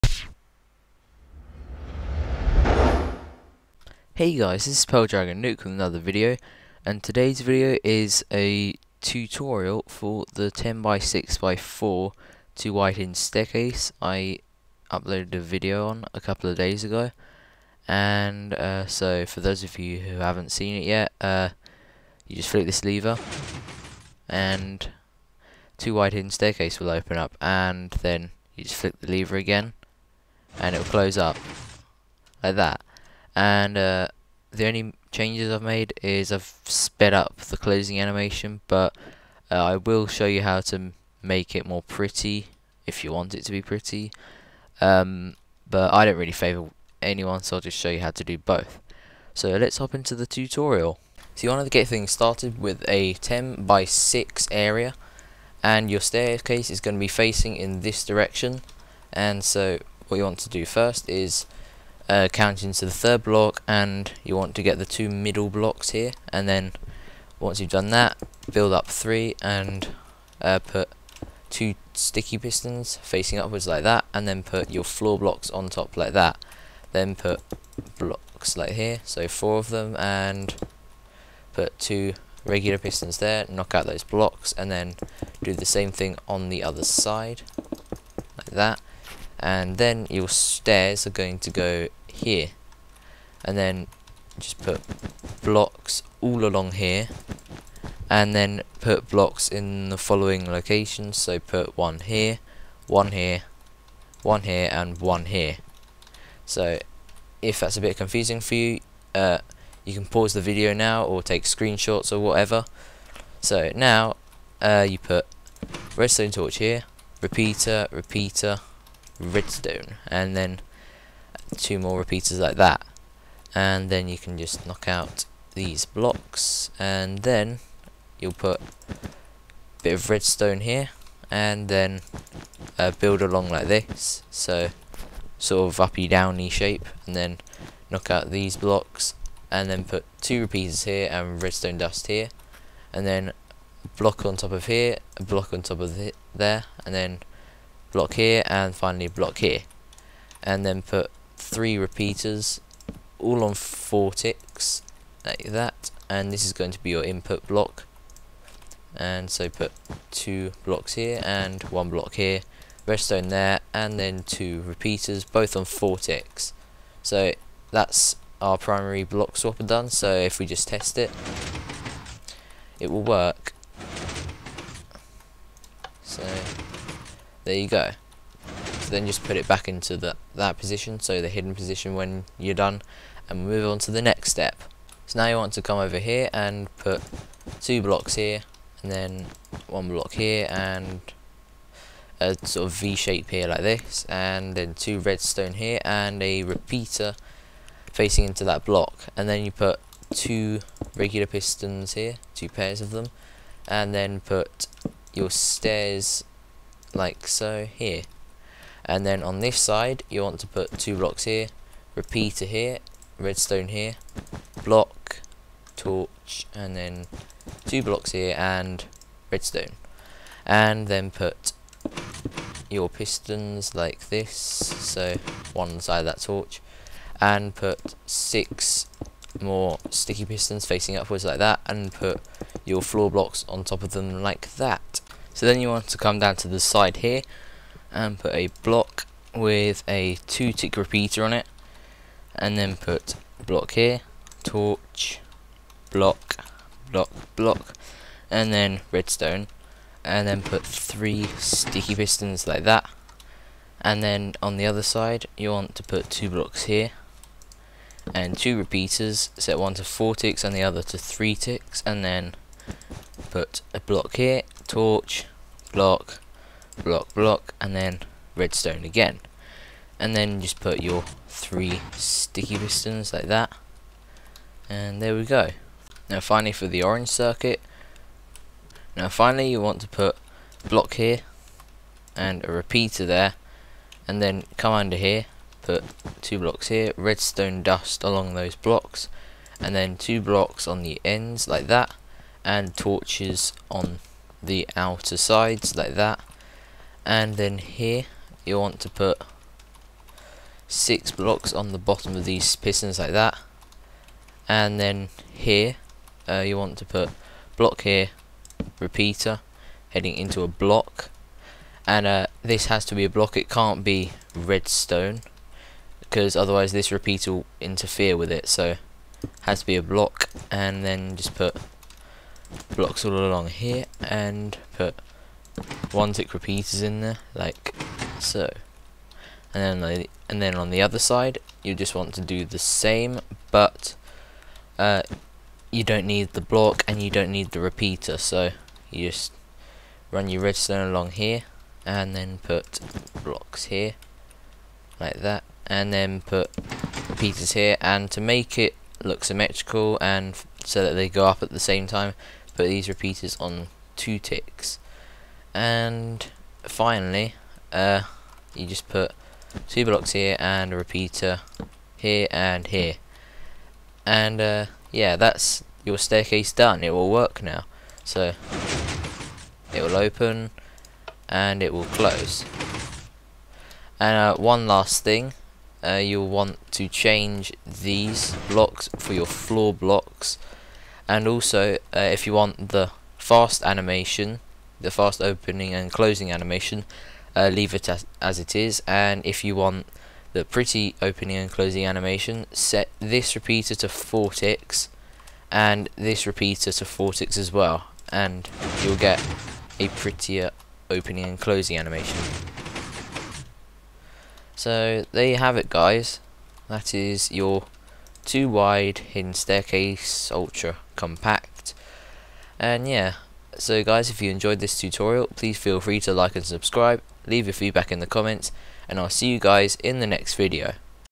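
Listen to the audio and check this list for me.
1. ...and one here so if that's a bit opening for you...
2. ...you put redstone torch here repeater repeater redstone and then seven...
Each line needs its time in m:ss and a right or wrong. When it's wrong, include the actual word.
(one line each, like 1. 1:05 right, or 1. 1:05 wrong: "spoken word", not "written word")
1. 1:44 wrong: "confusing", not "opening"
2. 1:54 wrong: "two", not "seven".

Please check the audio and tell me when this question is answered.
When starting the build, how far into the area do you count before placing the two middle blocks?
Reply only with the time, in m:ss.
1:02.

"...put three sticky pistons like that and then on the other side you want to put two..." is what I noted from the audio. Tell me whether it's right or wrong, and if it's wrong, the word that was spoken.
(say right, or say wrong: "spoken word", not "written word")
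right.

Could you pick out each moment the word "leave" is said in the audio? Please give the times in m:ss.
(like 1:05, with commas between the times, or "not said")
6:27, 6:57.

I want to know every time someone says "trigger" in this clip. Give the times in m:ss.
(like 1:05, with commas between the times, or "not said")
not said.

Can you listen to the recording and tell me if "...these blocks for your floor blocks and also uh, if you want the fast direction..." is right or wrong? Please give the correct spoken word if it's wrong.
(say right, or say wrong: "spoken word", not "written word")
wrong: "animation", not "direction".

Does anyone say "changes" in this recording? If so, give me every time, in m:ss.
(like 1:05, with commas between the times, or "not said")
0:35, 6:16.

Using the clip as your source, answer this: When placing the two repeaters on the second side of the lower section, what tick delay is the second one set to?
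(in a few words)
3 ticks.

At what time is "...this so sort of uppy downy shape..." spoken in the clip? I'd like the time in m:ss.
2:13.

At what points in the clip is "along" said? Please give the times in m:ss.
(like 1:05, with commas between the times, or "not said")
1:36, 2:13, 4:48, 5:23, 5:40.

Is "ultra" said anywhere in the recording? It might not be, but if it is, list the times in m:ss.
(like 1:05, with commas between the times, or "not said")
6:50.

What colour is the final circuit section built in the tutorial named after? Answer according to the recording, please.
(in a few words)
orange.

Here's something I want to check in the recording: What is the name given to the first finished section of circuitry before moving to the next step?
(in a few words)
primary block swapper.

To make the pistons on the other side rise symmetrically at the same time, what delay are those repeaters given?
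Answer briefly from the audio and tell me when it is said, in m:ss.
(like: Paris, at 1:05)
2 ticks, at 5:53.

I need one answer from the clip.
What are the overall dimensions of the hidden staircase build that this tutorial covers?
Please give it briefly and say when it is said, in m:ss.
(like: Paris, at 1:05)
10x6x4, at 0:10.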